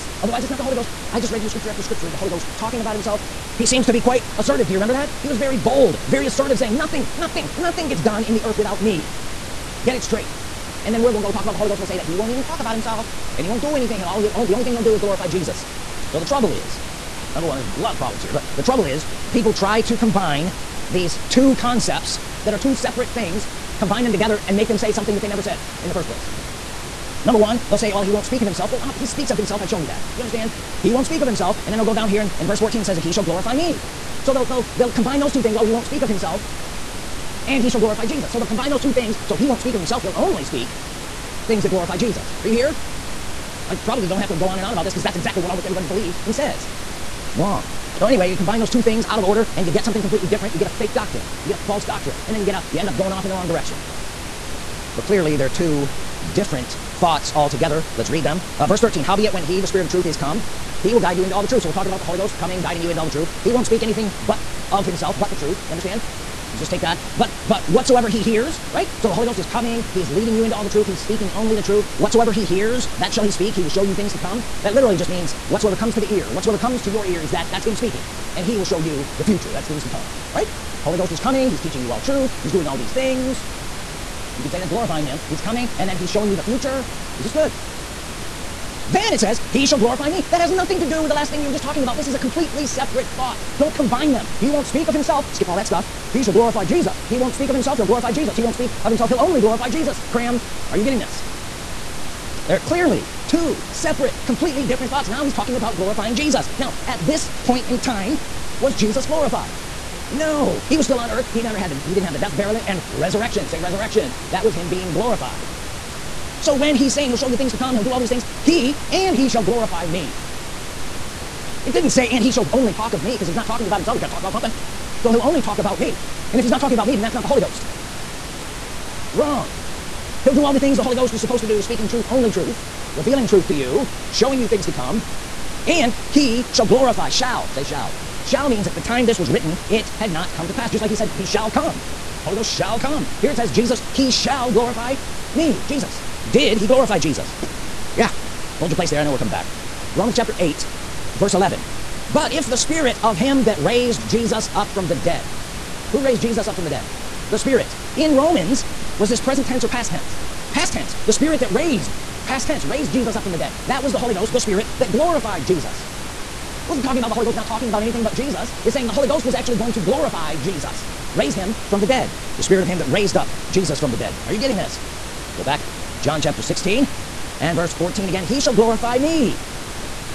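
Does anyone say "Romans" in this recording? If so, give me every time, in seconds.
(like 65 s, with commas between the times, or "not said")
149 s, 158 s.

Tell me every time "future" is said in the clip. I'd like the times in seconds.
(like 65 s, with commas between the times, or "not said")
79 s, 86 s.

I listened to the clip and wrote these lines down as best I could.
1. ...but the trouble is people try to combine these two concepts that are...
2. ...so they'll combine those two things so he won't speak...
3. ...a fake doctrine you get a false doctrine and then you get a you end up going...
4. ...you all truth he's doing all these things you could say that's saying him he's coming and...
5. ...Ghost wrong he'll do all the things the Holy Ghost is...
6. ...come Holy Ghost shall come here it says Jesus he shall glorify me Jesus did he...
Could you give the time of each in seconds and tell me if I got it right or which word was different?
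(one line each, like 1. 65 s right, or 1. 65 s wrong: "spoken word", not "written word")
1. 18 s right
2. 38 s right
3. 50 s right
4. 81 s wrong: "glorifying", not "saying"
5. 127 s right
6. 141 s right.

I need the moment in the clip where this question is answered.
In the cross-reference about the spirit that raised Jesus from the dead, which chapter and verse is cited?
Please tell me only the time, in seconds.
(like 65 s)
150 s.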